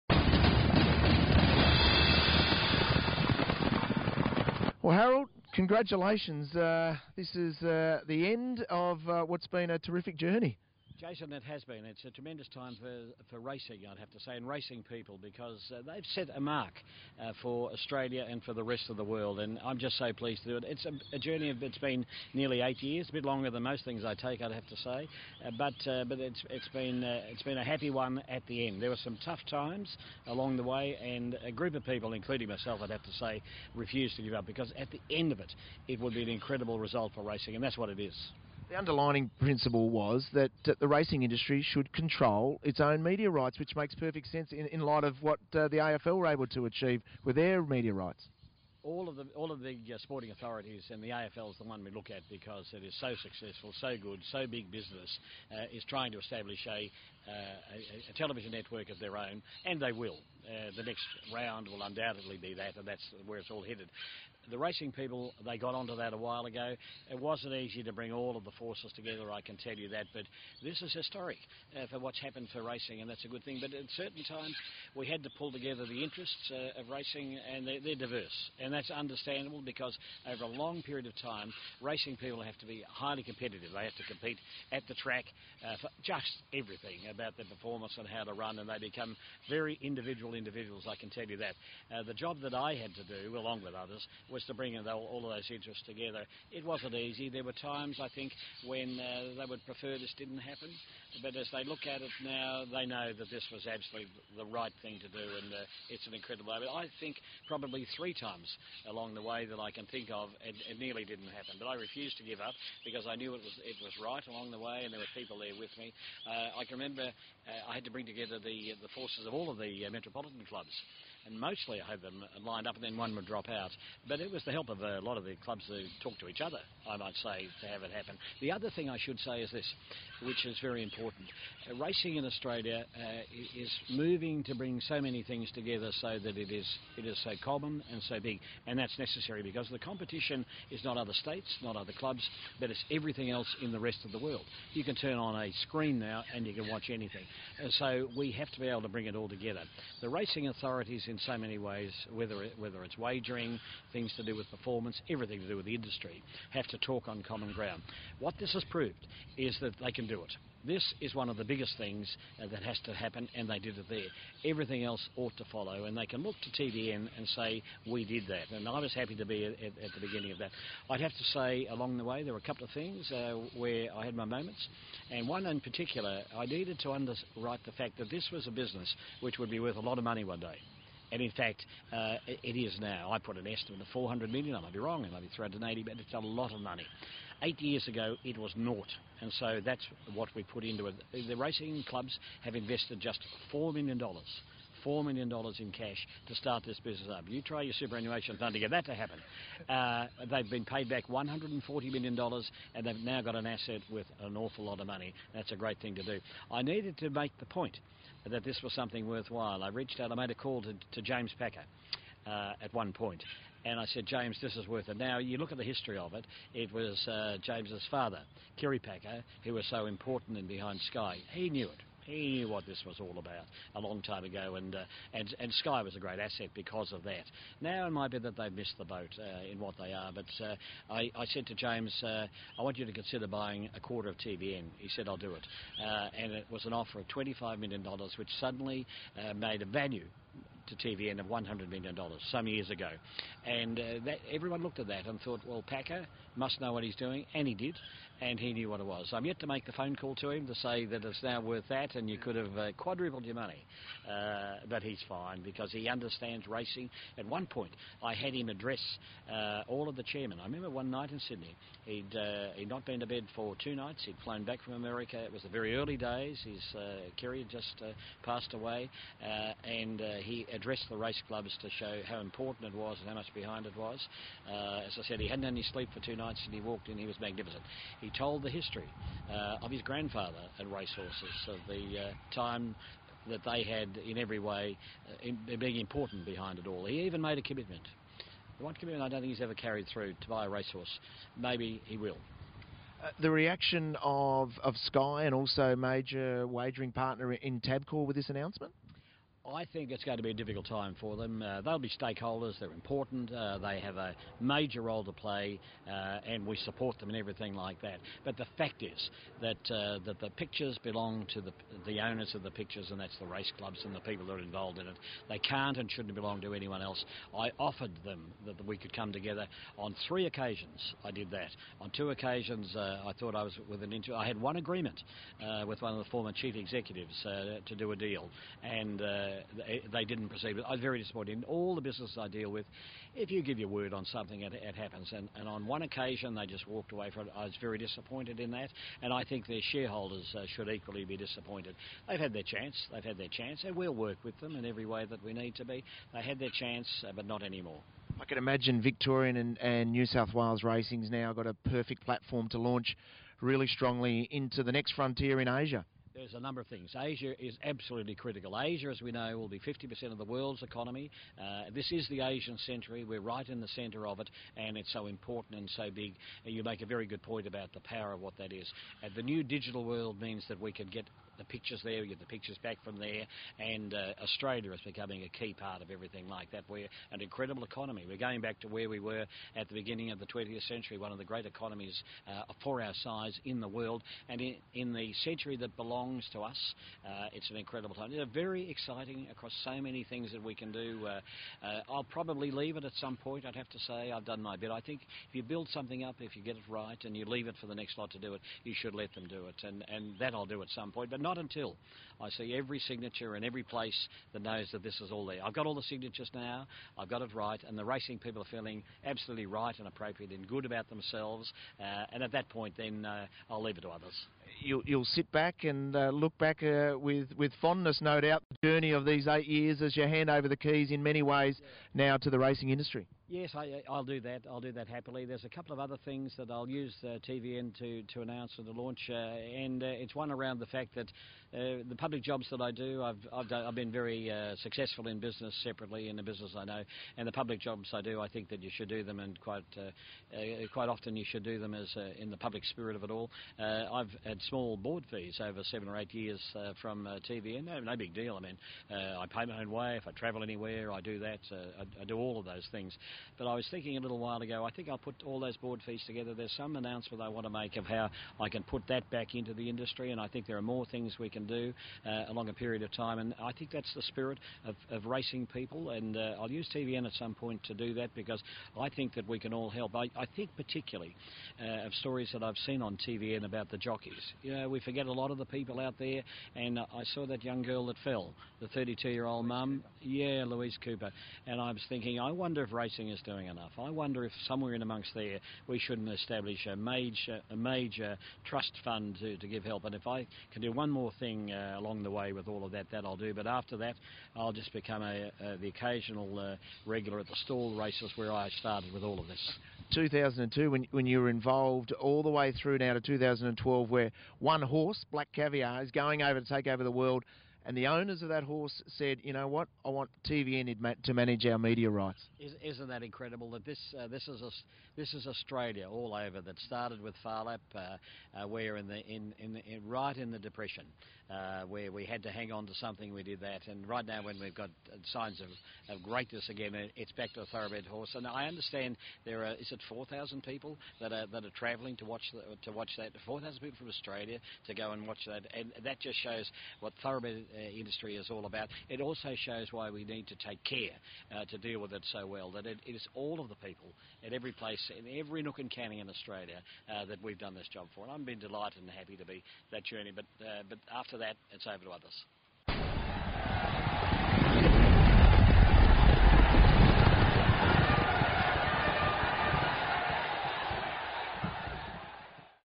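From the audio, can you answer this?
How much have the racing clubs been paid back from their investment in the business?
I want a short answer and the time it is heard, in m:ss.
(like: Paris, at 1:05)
$140 million, at 3:21.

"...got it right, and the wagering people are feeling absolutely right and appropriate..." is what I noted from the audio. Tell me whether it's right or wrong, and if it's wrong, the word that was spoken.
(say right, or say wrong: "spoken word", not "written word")
wrong: "racing", not "wagering".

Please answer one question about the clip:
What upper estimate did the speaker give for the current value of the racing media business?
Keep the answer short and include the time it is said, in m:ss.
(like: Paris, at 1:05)
$400 million, at 3:03.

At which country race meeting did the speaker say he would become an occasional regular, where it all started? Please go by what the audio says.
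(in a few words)
Stawell.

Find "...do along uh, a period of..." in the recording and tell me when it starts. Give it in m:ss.
7:41.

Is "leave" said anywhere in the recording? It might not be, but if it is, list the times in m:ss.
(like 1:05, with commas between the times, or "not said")
6:32, 6:37, 6:53.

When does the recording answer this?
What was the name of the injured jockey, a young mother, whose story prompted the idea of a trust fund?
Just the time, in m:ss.
8:00.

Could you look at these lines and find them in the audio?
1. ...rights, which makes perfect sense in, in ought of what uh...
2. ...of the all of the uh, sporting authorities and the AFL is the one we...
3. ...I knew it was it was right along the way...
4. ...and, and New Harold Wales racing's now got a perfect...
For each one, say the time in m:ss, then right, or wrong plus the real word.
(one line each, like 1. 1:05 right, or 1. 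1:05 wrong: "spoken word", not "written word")
1. 0:43 wrong: "light", not "ought"
2. 0:49 right
3. 1:53 right
4. 5:49 wrong: "South", not "Harold".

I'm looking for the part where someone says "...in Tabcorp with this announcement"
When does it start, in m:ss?
4:57.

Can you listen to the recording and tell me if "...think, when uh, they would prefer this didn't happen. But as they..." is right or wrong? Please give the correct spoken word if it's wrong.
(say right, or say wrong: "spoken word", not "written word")
right.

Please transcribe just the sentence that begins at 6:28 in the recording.
It's very exciting across so many things that we can do.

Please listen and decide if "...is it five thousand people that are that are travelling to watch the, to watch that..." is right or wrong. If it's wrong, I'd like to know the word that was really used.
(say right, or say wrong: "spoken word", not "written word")
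wrong: "four", not "five".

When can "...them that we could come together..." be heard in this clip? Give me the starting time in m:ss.
5:18.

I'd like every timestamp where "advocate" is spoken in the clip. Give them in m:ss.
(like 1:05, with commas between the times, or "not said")
not said.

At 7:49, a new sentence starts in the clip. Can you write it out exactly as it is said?
I, I think particularly uh, of stories that I've seen on TVN about the jockeys.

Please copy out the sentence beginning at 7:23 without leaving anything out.
Uh, I've had small board fees over seven or eight years uh, from TVN, no, no, big deal.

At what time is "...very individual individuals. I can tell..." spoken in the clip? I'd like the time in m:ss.
1:29.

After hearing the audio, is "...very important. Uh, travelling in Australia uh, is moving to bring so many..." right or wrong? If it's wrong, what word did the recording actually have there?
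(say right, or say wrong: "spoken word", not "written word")
wrong: "racing", not "travelling".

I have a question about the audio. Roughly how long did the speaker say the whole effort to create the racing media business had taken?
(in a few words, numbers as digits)
nearly 8 years.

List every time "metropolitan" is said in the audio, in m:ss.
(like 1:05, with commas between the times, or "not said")
1:59.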